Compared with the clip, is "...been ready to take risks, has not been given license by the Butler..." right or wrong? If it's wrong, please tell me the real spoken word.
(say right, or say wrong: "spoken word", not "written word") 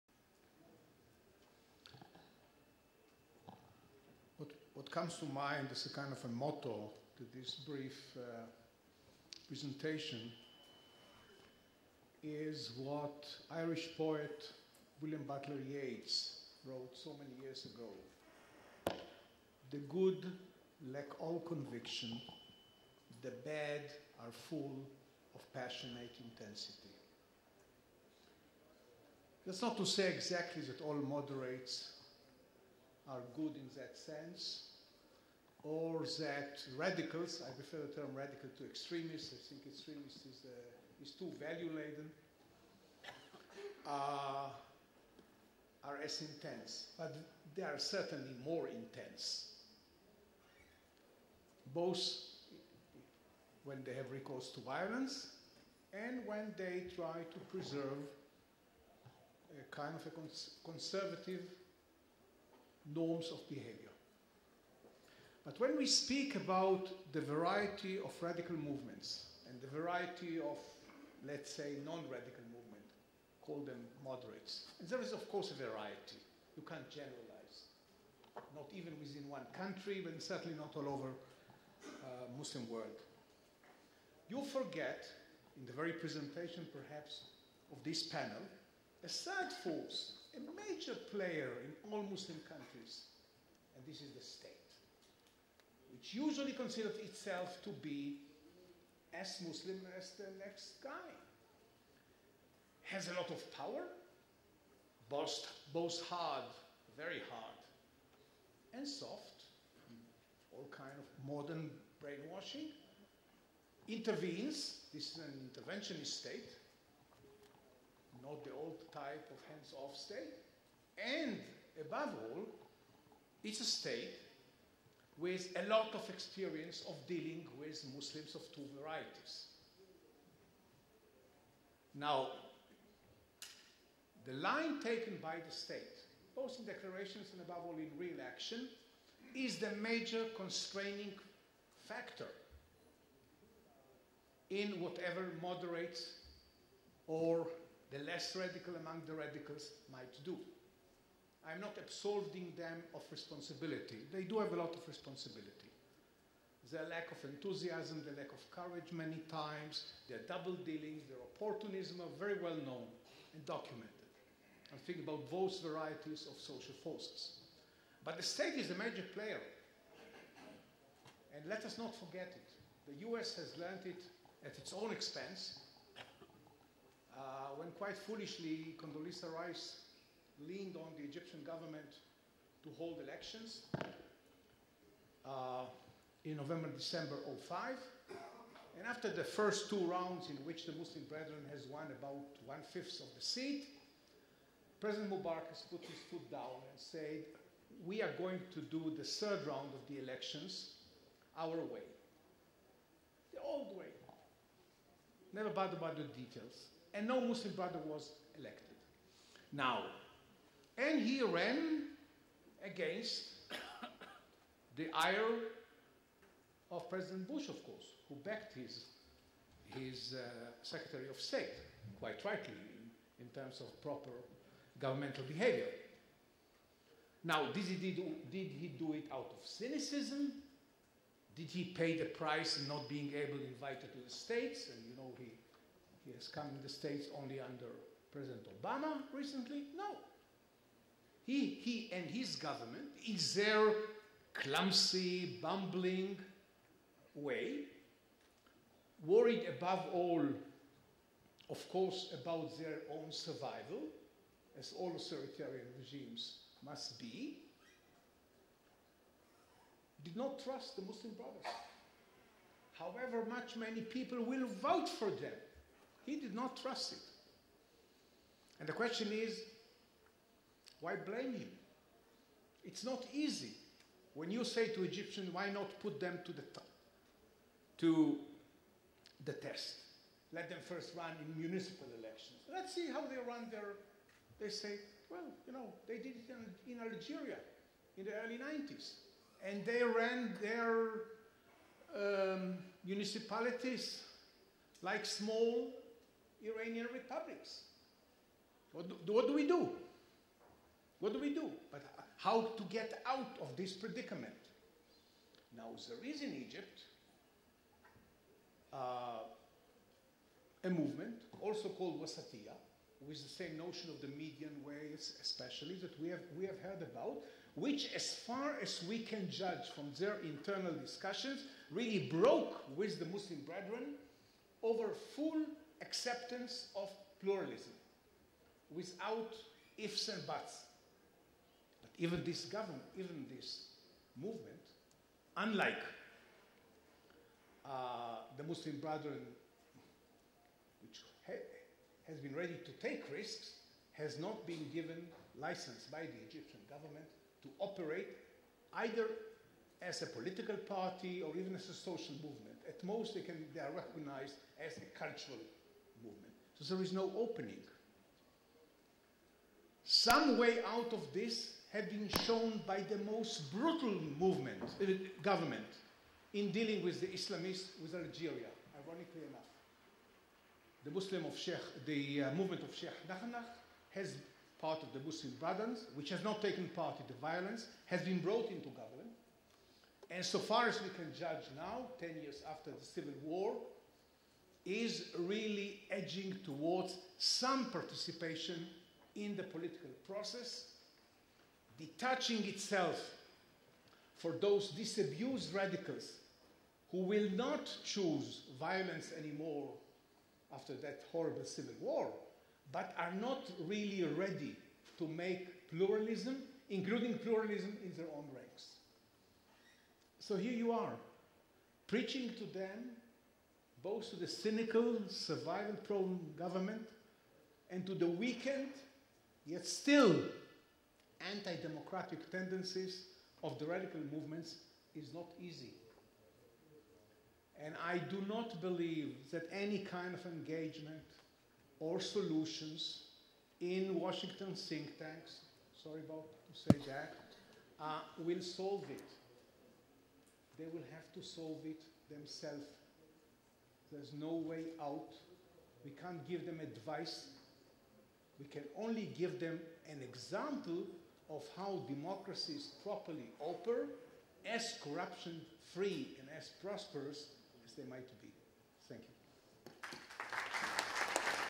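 wrong: "Egyptian", not "Butler".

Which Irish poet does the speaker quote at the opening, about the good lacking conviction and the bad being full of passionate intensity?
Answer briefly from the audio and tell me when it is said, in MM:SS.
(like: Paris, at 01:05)
William Butler Yeats, at 00:15.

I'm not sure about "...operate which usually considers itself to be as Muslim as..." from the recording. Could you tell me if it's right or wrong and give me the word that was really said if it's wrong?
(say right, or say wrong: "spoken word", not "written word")
wrong: "state", not "operate".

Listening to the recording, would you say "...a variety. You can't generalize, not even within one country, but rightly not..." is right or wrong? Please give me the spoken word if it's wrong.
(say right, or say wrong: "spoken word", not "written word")
wrong: "certainly", not "rightly".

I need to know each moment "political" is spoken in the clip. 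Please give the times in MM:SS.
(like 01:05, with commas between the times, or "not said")
05:50, 06:29.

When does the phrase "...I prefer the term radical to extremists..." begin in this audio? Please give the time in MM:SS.
00:37.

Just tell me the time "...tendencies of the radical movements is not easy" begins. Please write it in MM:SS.
07:02.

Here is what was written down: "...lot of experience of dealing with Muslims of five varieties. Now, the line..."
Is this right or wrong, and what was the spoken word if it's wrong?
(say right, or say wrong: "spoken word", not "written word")
wrong: "two", not "five".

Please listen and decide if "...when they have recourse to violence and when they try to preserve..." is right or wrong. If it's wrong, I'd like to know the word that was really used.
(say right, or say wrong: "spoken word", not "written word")
right.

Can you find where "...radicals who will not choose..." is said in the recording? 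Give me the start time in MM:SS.
06:35.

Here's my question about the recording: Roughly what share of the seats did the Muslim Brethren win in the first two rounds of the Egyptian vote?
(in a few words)
one-fifth.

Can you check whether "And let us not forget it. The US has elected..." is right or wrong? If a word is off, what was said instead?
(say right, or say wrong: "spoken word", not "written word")
wrong: "learned", not "elected".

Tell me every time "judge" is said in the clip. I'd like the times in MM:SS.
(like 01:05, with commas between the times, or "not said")
05:19, 06:21.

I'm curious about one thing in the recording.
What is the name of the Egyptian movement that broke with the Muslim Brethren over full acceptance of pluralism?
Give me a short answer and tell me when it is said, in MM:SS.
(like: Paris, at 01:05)
Wasatiyah, at 05:12.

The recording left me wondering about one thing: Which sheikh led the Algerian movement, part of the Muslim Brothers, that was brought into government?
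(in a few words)
Sheikh Nahnah.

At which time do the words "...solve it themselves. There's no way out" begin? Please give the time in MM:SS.
07:21.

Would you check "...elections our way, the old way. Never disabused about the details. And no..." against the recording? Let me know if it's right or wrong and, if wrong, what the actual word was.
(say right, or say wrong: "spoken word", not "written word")
wrong: "bothered", not "disabused".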